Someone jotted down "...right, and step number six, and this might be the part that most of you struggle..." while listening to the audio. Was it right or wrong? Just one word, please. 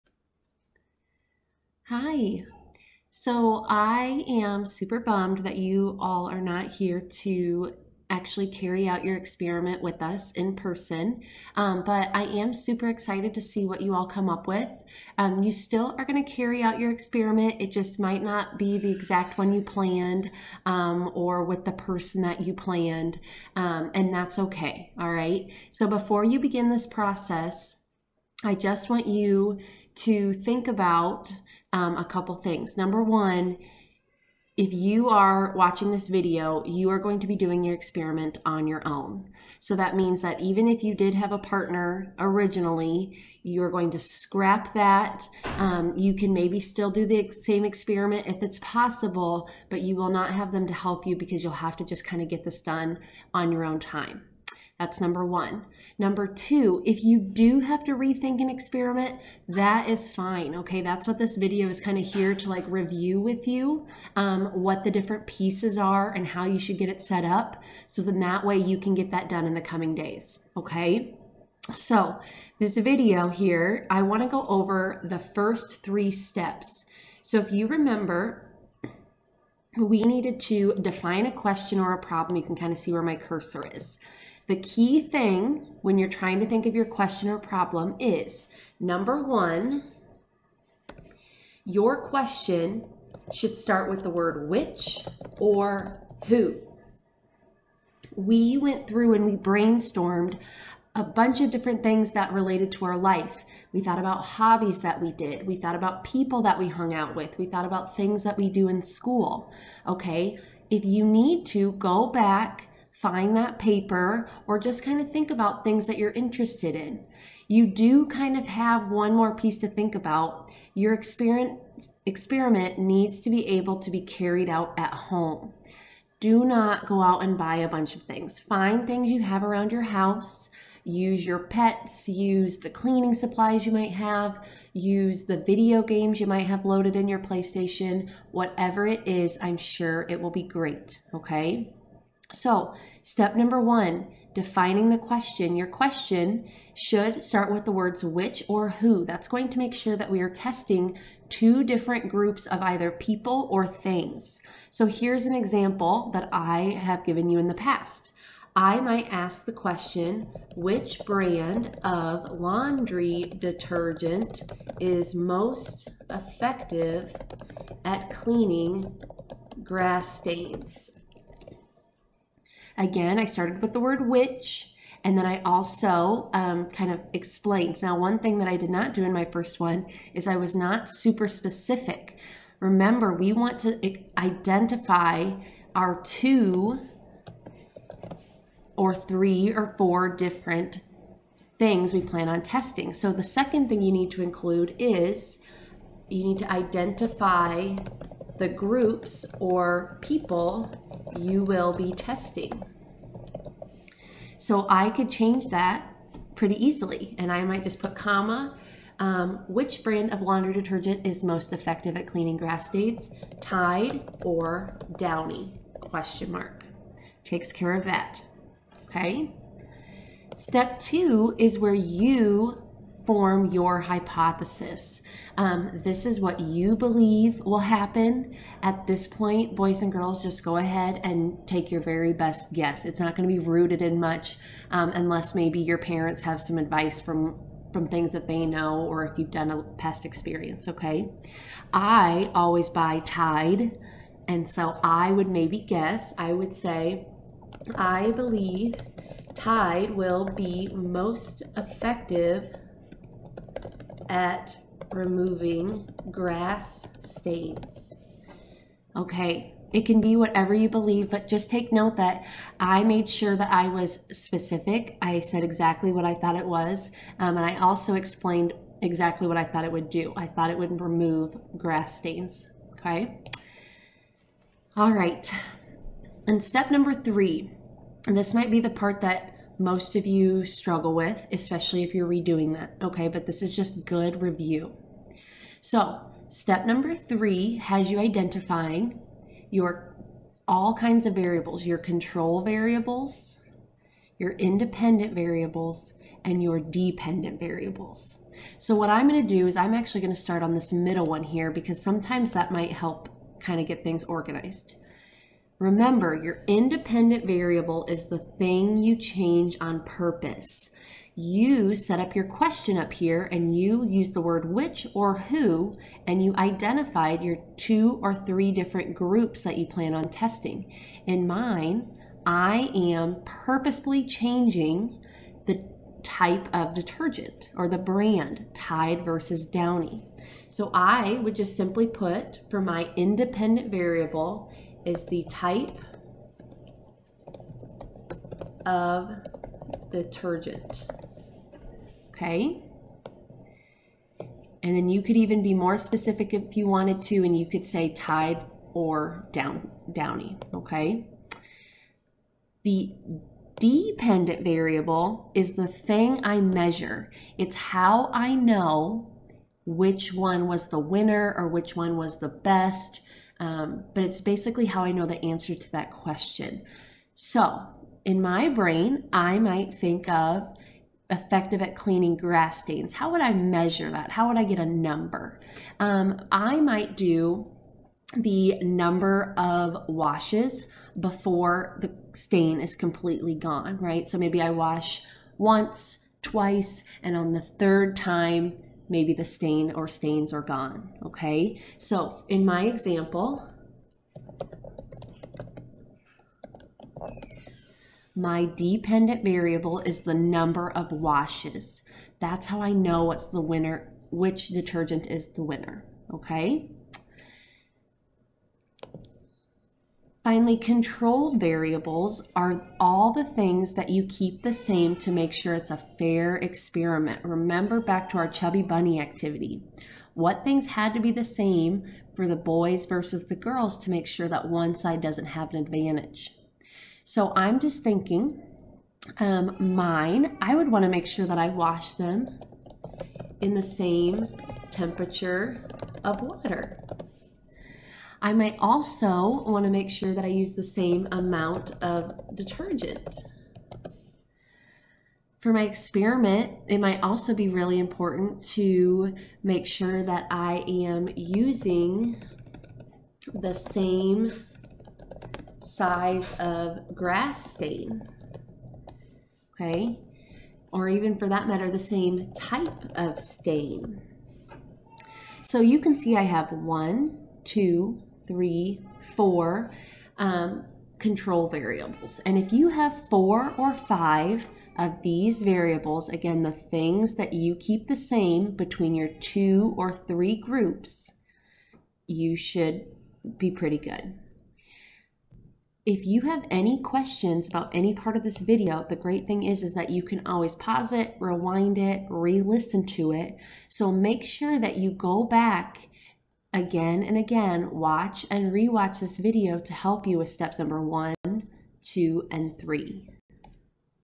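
wrong.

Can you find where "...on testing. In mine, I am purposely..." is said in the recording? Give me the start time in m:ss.
5:19.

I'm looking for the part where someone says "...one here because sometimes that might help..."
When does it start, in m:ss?
5:01.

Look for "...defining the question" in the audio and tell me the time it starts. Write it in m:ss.
2:24.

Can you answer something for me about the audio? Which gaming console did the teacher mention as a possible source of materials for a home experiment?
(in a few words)
PlayStation.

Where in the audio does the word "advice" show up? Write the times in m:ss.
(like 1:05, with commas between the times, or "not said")
3:56.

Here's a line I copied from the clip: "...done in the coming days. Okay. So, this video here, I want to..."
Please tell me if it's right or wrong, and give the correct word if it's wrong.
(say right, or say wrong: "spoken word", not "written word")
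right.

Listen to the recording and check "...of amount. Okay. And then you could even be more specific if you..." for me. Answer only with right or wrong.
wrong.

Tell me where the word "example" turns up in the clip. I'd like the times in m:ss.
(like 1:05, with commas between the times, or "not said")
2:35, 6:32.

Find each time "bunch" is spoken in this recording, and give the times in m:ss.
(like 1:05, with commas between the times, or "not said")
1:41, 2:07.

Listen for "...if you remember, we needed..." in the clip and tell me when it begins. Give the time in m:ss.
1:17.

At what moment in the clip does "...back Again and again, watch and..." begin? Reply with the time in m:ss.
8:15.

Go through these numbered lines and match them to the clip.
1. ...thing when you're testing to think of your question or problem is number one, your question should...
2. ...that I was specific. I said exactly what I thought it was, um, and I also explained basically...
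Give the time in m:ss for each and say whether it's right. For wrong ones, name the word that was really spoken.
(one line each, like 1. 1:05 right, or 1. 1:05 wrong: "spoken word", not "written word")
1. 1:24 wrong: "trying", not "testing"
2. 4:23 wrong: "exactly", not "basically".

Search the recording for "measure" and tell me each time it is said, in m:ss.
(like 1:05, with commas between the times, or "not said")
5:56, 6:13.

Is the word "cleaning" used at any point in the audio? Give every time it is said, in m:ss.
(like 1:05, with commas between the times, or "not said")
2:12, 2:48, 3:32, 6:11.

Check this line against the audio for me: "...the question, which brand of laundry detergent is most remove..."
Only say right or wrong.
wrong.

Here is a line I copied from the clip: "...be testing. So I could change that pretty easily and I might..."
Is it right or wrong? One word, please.
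right.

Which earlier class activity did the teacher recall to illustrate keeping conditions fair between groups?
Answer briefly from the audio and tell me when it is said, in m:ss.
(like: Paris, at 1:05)
chubby bunny, at 6:58.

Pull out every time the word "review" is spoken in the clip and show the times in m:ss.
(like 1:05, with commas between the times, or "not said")
1:02, 4:44.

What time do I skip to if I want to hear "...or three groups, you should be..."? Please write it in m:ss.
7:59.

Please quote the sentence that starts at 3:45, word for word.
Um, this is what you believe will happen.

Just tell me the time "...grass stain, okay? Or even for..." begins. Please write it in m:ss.
7:36.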